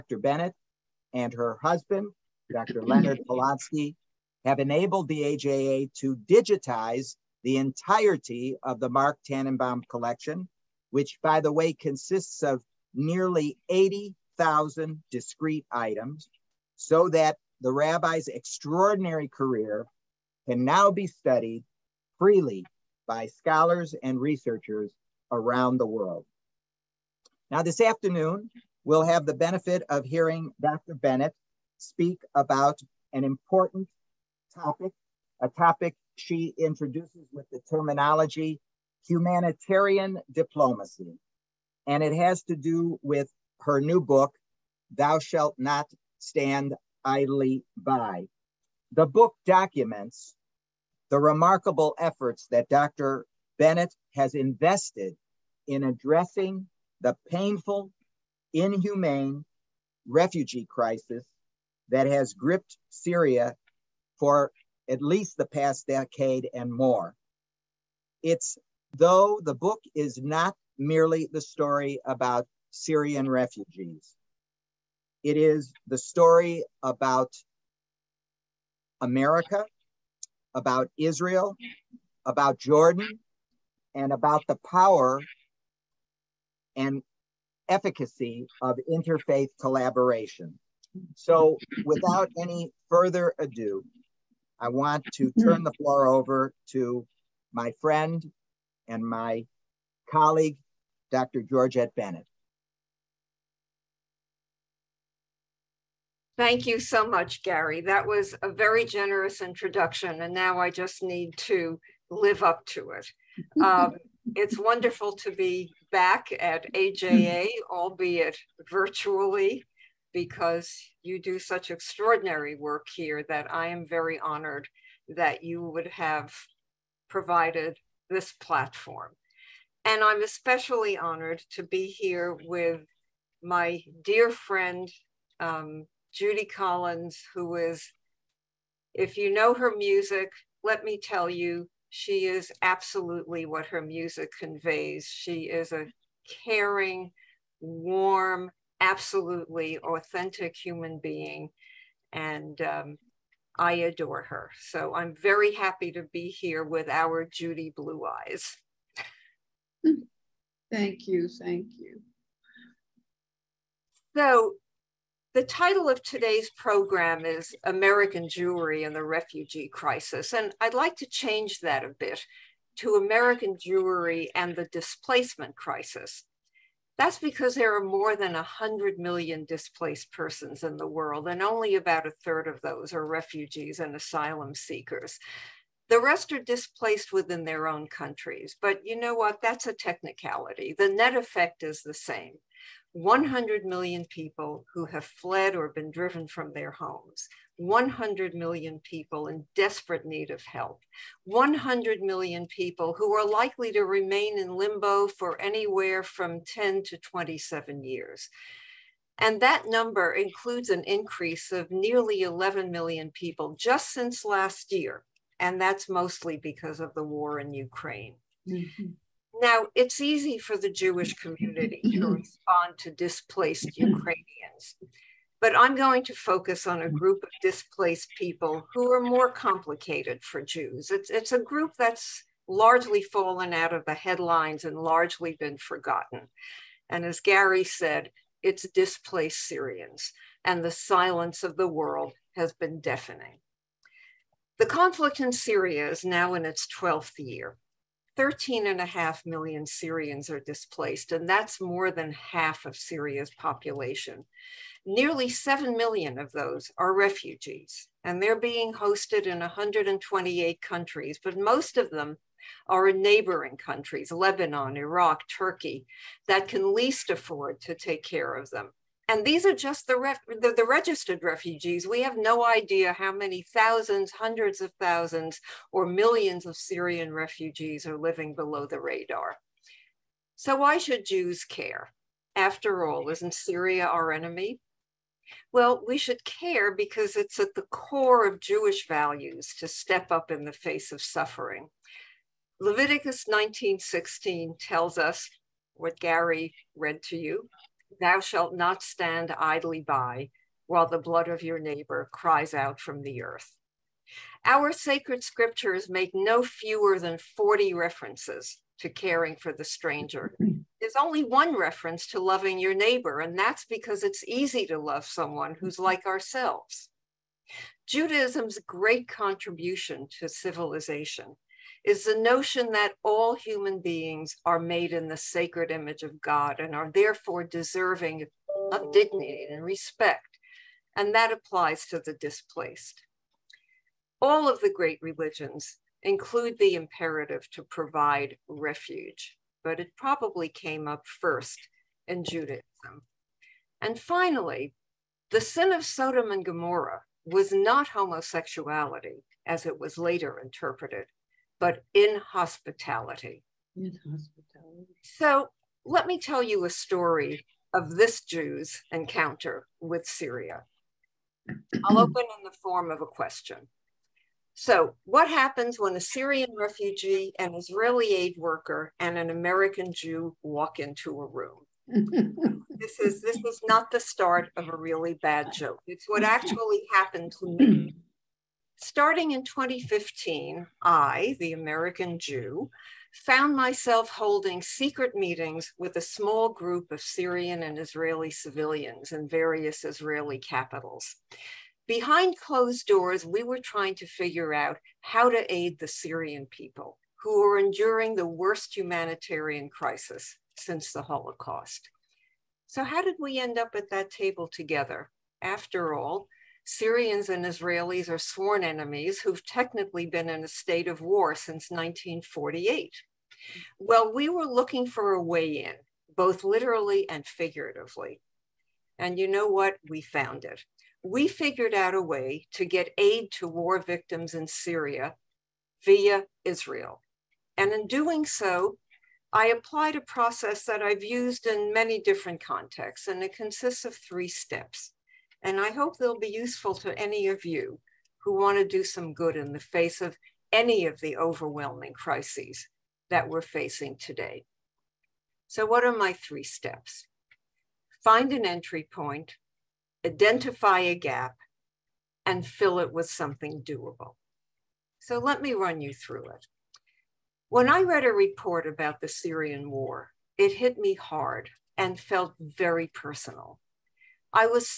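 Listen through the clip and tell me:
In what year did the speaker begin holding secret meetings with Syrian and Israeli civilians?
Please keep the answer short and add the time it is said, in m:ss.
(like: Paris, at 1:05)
2015, at 6:19.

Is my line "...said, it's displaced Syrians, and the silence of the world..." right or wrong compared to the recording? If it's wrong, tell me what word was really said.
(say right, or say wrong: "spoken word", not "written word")
right.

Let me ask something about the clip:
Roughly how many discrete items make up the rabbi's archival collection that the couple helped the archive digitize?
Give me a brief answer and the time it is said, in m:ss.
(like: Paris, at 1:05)
80,000, at 0:12.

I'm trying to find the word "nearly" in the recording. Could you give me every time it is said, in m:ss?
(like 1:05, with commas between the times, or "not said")
0:12, 3:31, 4:14.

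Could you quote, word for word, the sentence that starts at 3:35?
And that's mostly because of the war in Ukraine.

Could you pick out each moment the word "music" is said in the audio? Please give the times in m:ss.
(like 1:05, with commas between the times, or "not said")
2:19, 2:23.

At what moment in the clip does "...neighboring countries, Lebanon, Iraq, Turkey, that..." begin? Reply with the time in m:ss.
4:23.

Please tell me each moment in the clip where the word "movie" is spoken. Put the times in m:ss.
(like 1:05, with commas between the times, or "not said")
not said.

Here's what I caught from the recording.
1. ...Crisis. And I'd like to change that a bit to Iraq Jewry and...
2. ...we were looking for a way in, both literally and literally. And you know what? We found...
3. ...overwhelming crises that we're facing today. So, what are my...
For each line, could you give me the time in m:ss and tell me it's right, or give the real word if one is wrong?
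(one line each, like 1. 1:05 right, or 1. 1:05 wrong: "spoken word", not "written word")
1. 2:49 wrong: "American", not "Iraq"
2. 6:54 wrong: "figuratively", not "literally"
3. 7:21 right.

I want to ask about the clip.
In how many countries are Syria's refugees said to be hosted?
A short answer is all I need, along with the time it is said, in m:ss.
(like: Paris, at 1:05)
128, at 4:19.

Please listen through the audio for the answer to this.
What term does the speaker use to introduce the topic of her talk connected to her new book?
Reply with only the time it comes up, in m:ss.
0:39.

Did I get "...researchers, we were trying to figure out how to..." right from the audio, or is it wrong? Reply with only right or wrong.
wrong.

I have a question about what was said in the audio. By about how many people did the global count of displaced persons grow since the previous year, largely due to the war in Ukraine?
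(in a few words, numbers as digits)
11 million.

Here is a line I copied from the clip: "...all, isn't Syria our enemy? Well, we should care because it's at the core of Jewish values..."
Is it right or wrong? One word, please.
right.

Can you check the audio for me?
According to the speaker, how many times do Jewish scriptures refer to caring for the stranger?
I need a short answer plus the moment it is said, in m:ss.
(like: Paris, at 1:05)
40, at 5:06.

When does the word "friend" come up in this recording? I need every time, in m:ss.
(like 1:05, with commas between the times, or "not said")
1:37, 2:14.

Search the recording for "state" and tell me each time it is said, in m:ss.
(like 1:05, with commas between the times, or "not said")
6:50.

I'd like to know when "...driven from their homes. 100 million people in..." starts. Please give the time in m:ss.
3:15.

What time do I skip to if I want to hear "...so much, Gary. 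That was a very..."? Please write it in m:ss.
1:46.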